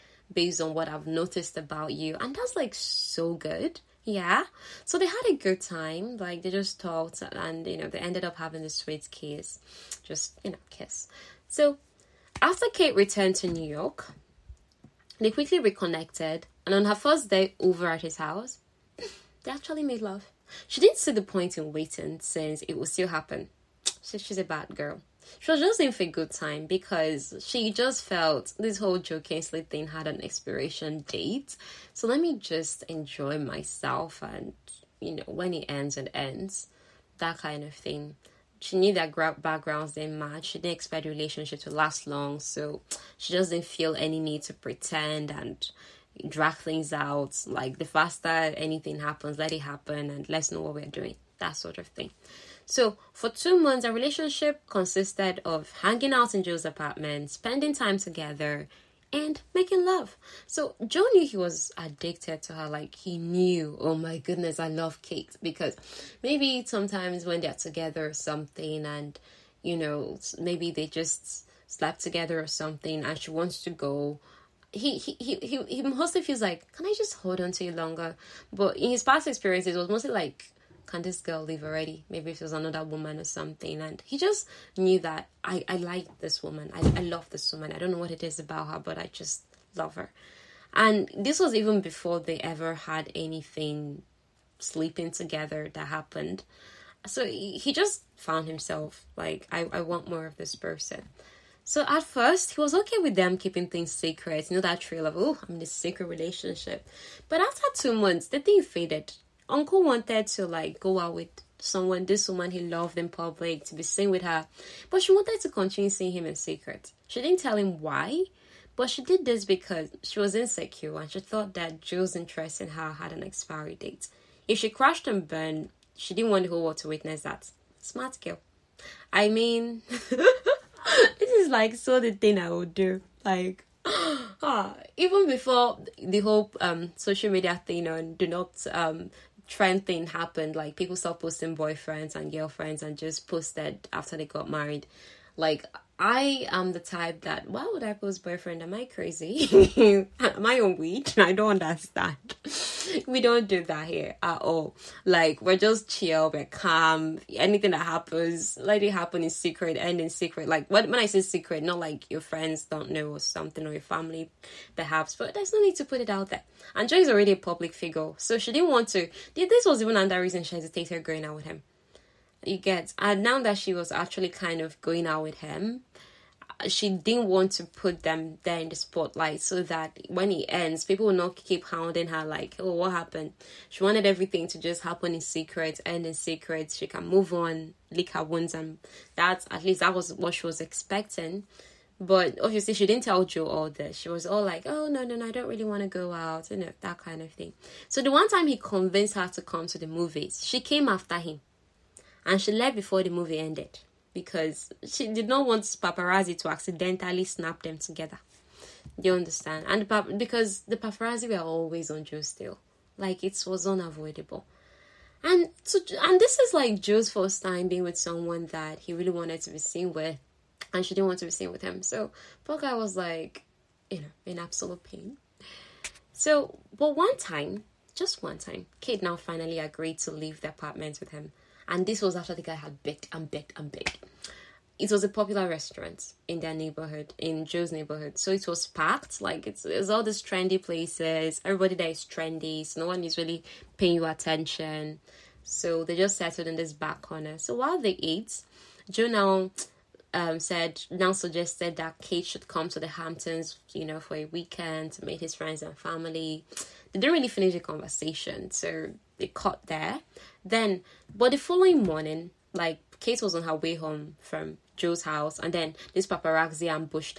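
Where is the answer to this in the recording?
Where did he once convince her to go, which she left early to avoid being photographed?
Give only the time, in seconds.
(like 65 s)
199 s.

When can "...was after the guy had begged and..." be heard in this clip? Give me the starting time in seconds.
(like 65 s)
232 s.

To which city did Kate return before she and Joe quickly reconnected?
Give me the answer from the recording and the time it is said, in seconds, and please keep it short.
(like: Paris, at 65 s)
New York, at 13 s.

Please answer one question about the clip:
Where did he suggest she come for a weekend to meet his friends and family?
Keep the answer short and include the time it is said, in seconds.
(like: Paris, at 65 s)
The Hamptons, at 252 s.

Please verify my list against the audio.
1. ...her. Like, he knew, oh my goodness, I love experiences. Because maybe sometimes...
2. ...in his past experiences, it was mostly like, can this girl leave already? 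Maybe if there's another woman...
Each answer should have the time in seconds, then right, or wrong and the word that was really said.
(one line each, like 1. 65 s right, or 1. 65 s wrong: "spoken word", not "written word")
1. 62 s wrong: "cakes", not "experiences"
2. 78 s right.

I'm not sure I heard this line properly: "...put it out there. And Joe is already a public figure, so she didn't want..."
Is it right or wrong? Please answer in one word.
right.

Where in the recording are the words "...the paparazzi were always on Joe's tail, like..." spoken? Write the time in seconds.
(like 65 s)
210 s.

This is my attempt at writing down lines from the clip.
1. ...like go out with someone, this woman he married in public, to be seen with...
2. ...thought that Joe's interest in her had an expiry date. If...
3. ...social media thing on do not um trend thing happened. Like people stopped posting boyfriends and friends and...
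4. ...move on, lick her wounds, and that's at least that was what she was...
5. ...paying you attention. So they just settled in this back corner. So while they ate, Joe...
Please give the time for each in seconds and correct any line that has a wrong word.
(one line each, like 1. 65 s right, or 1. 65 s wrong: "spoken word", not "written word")
1. 110 s wrong: "loved", not "married"
2. 121 s right
3. 136 s wrong: "girlfriends", not "friends"
4. 187 s right
5. 243 s right.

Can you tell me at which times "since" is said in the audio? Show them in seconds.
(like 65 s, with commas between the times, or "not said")
22 s.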